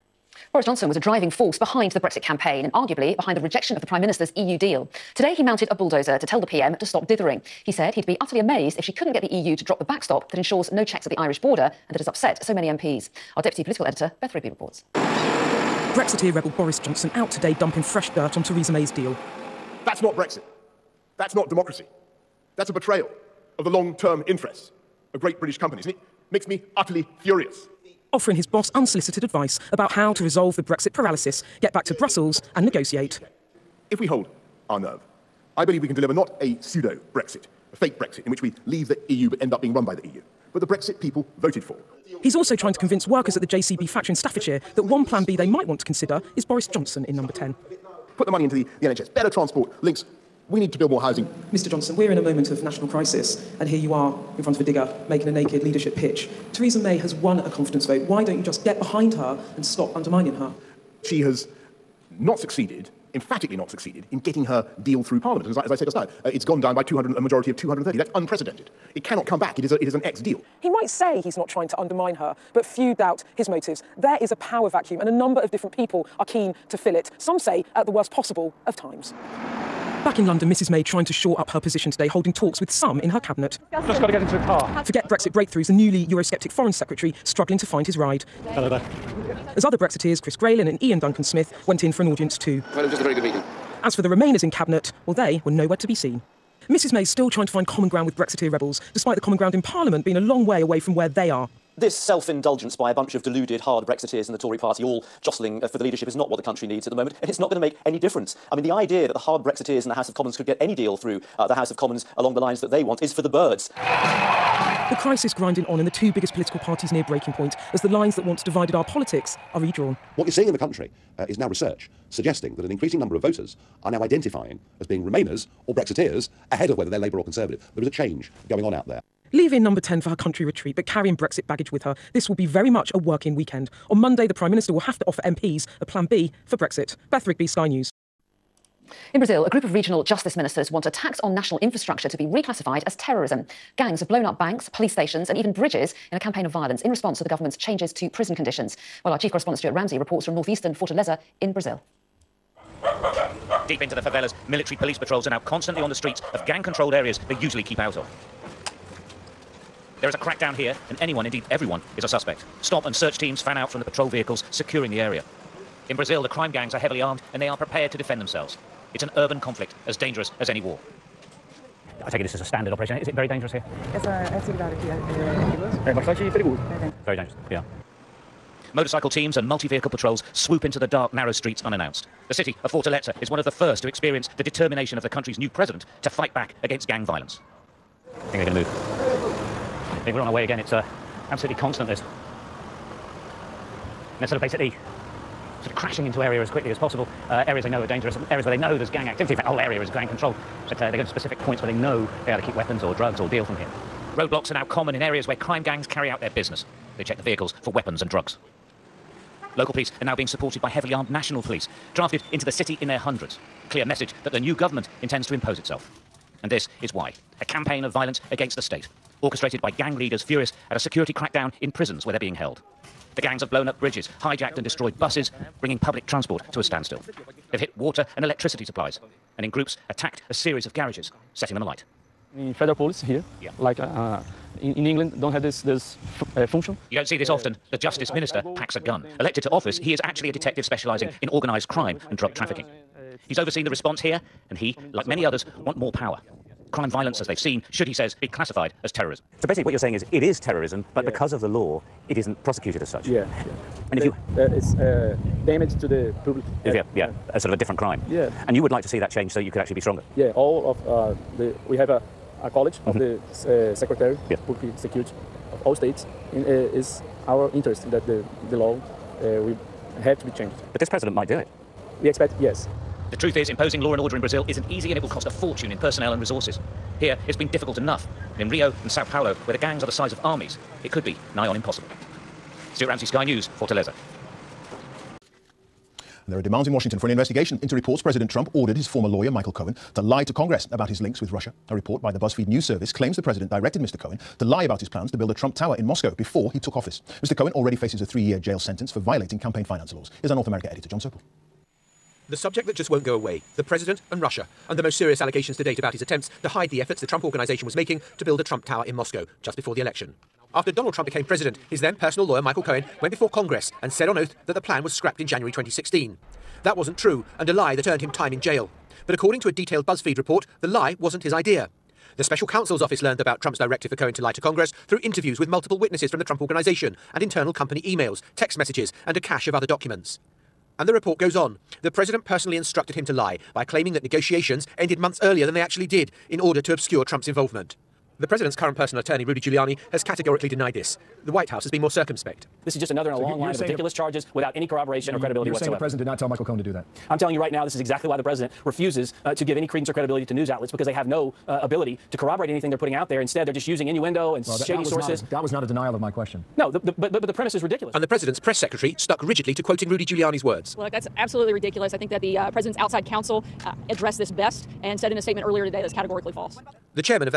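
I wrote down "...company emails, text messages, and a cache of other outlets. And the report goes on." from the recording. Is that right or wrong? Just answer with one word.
wrong.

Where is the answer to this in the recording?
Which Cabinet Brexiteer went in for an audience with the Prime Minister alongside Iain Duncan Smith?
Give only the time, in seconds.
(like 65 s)
90 s.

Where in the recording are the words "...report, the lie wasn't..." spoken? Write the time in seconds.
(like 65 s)
320 s.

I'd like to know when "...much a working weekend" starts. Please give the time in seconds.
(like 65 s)
132 s.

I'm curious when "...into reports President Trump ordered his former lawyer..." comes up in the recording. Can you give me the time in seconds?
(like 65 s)
287 s.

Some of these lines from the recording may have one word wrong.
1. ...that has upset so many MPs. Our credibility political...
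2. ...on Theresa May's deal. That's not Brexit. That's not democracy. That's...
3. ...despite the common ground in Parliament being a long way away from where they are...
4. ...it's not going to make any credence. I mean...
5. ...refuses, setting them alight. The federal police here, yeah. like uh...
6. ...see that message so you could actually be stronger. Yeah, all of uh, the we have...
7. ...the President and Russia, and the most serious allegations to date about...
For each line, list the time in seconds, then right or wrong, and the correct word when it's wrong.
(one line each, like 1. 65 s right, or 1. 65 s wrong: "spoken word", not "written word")
1. 11 s wrong: "deputy", not "credibility"
2. 18 s right
3. 98 s right
4. 107 s wrong: "difference", not "credence"
5. 230 s wrong: "garages", not "refuses"
6. 258 s wrong: "change", not "message"
7. 303 s right.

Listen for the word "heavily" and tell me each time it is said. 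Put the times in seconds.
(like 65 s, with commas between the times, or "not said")
166 s, 210 s.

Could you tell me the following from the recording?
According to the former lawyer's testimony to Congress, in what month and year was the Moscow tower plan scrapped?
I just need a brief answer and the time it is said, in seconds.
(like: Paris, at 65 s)
January 2016, at 315 s.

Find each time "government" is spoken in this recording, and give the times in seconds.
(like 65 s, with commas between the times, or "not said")
147 s, 214 s.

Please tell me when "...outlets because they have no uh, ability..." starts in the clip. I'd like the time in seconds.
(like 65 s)
350 s.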